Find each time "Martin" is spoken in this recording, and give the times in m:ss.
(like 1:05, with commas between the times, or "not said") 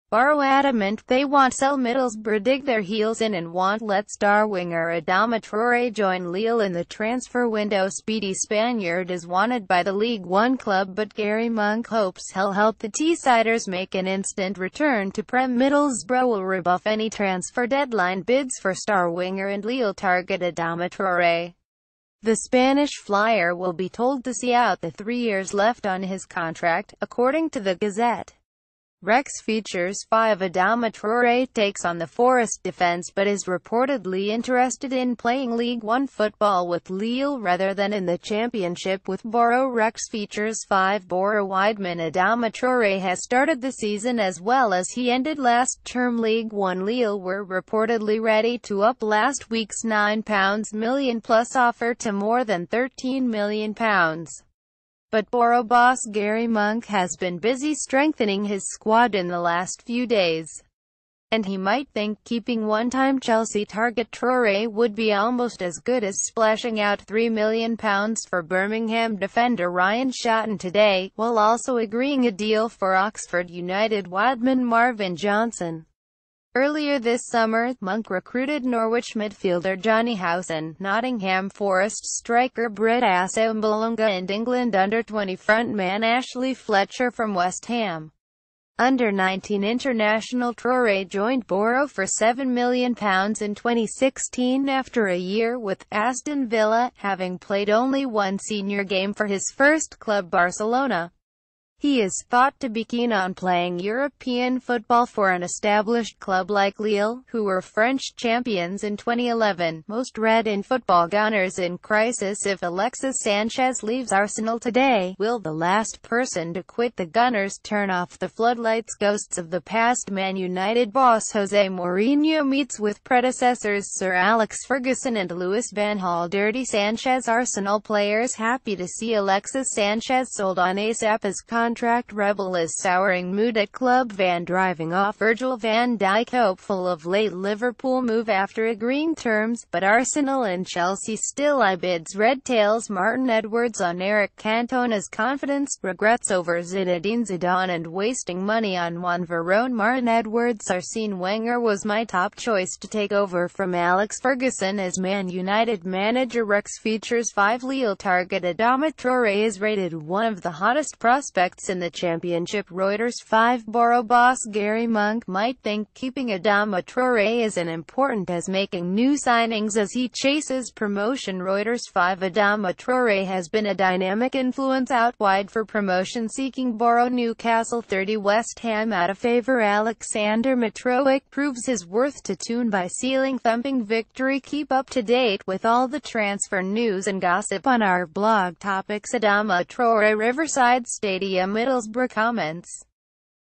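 2:22, 2:29.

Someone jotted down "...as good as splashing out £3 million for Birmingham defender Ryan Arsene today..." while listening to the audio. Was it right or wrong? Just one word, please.
wrong.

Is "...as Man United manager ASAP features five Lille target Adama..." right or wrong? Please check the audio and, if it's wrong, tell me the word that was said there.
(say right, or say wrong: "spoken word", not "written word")
wrong: "Rex", not "ASAP".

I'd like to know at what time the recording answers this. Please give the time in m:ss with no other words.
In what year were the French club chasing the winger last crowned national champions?
1:48.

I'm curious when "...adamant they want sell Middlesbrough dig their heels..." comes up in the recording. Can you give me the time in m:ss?
0:00.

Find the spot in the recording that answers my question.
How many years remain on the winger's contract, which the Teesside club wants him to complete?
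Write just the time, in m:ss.
0:24.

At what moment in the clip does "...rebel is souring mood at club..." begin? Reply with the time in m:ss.
2:12.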